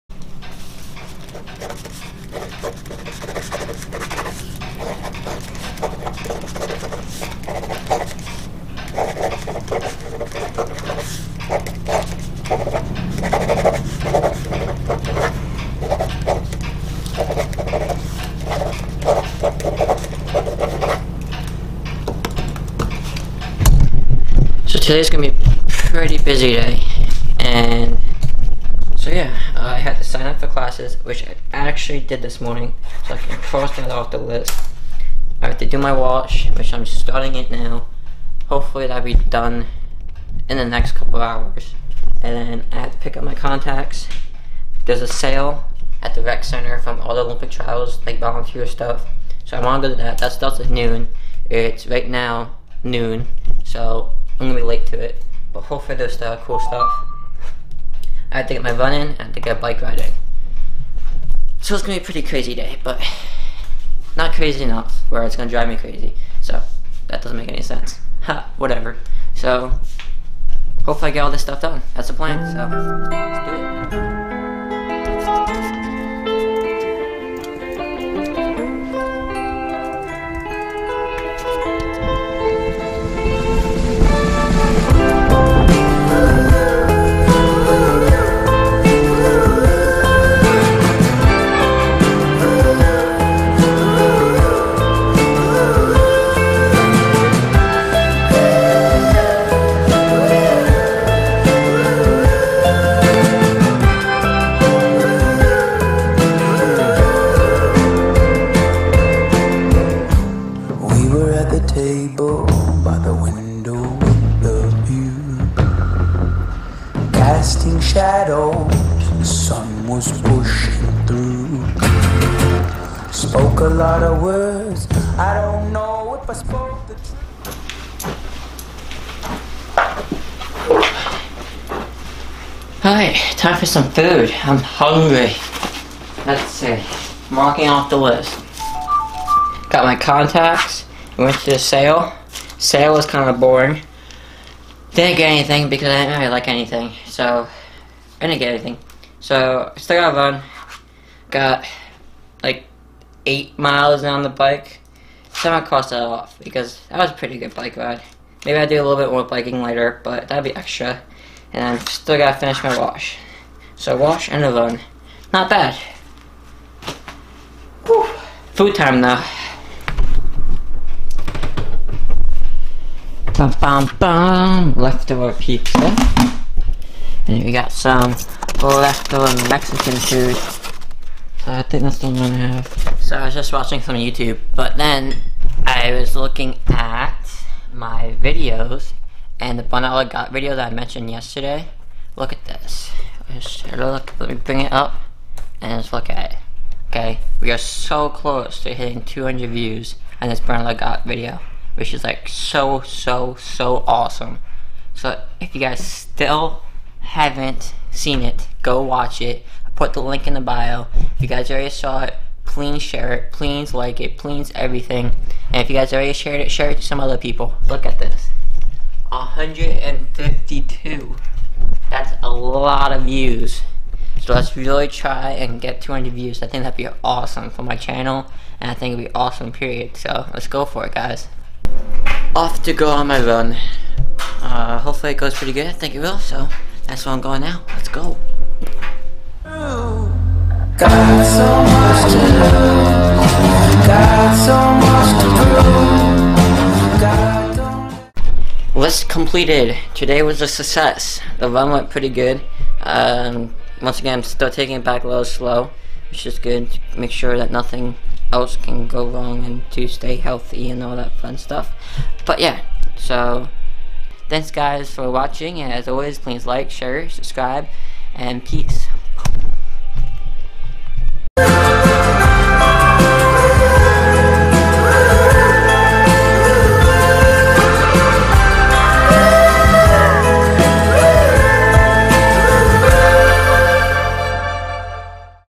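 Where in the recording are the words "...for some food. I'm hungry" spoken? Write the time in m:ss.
2:13.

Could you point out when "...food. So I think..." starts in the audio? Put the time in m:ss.
2:59.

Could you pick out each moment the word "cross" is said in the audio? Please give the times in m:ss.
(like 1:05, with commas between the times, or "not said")
0:33, 2:35.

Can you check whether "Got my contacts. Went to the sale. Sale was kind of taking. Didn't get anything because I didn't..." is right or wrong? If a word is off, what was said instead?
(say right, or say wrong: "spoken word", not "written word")
wrong: "boring", not "taking".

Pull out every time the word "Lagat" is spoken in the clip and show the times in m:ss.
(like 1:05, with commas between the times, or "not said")
3:10, 3:20.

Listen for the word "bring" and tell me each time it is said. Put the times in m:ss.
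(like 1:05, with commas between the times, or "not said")
3:14.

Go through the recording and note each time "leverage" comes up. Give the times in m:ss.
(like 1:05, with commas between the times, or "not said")
not said.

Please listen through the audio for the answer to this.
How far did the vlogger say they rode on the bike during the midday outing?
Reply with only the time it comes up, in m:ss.
2:33.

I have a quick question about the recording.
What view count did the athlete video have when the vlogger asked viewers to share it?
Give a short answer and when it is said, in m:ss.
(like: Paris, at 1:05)
152, at 3:39.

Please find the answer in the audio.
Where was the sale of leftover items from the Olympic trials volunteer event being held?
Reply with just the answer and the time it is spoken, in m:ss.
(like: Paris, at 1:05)
rec center, at 0:46.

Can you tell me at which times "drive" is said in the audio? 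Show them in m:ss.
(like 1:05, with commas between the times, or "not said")
1:05.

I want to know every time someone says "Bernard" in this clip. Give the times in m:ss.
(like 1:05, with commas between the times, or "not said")
3:09, 3:20.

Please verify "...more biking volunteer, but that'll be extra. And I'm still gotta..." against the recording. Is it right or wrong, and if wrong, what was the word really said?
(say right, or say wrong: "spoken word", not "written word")
wrong: "later", not "volunteer".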